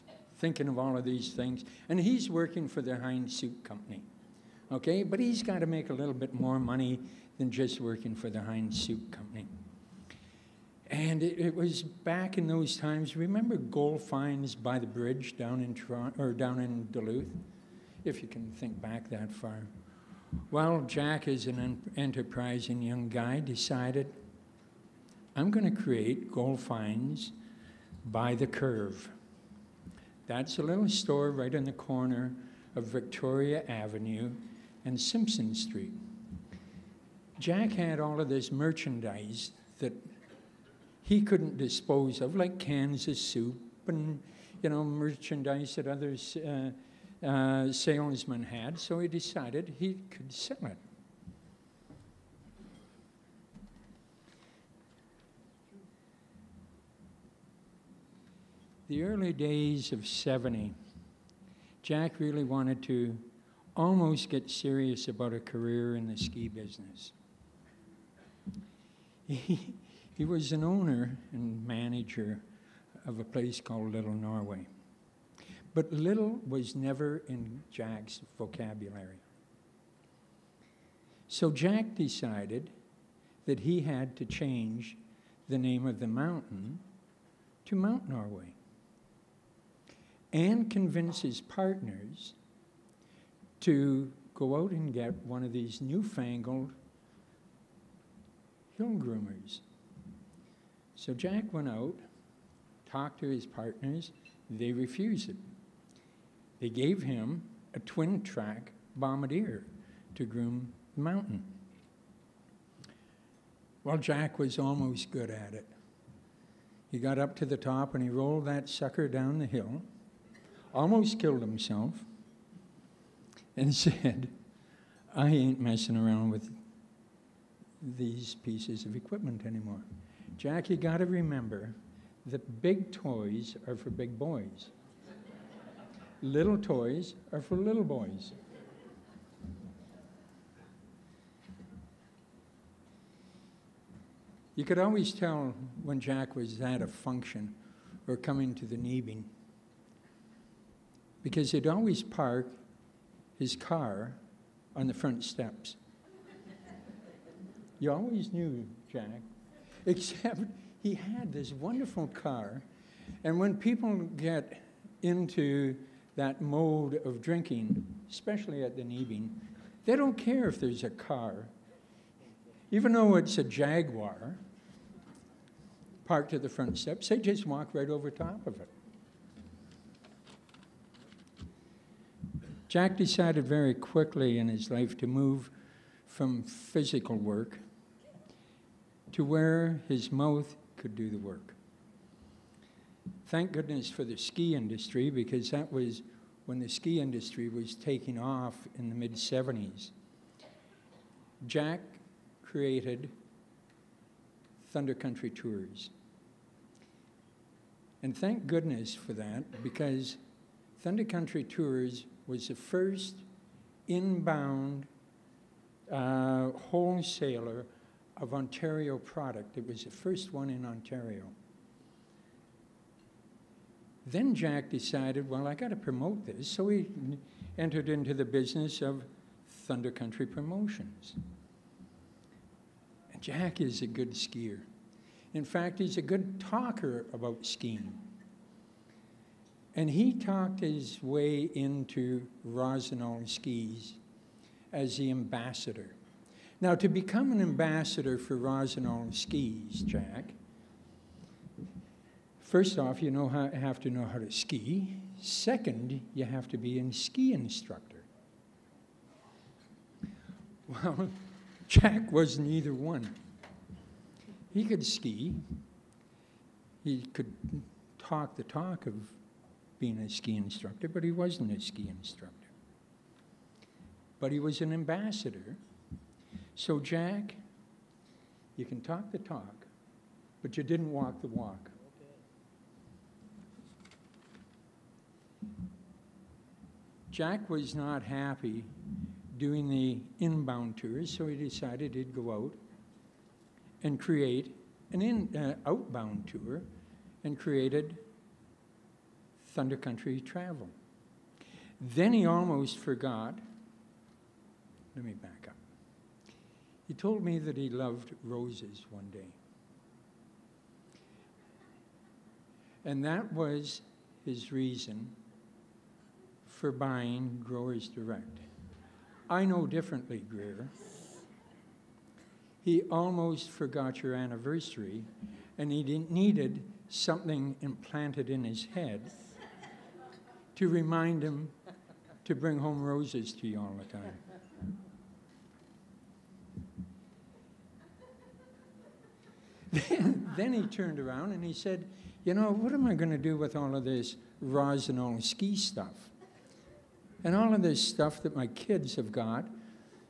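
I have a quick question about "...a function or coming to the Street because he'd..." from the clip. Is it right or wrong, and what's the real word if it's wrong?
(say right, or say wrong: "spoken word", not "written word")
wrong: "Neebing", not "Street".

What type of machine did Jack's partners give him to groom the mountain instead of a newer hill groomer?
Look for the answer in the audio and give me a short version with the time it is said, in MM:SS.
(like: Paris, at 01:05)
twin track bombardier, at 01:47.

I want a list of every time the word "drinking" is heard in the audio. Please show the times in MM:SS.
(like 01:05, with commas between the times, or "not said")
02:47.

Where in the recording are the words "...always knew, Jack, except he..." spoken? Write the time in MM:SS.
02:37.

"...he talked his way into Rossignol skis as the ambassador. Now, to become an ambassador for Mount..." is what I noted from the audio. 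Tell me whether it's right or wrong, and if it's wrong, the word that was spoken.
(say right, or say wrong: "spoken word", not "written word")
wrong: "Rossignol", not "Mount".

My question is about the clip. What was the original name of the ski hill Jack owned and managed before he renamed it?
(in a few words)
Little Norway.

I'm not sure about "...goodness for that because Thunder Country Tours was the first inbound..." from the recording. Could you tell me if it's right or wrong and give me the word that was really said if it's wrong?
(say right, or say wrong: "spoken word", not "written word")
right.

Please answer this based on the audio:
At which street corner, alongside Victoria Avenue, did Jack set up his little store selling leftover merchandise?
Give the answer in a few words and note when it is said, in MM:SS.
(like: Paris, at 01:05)
Simpson Street, at 00:34.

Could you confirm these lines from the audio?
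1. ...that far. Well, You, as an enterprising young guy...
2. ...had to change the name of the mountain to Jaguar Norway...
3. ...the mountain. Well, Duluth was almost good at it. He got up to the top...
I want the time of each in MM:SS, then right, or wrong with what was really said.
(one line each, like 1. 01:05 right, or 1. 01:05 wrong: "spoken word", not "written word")
1. 00:19 wrong: "Jack", not "You"
2. 01:23 wrong: "Mount", not "Jaguar"
3. 01:50 wrong: "Jack", not "Duluth".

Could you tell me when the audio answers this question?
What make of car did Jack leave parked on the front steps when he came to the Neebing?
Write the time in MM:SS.
02:53.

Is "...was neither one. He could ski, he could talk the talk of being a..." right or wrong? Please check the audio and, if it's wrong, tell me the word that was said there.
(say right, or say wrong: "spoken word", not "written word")
right.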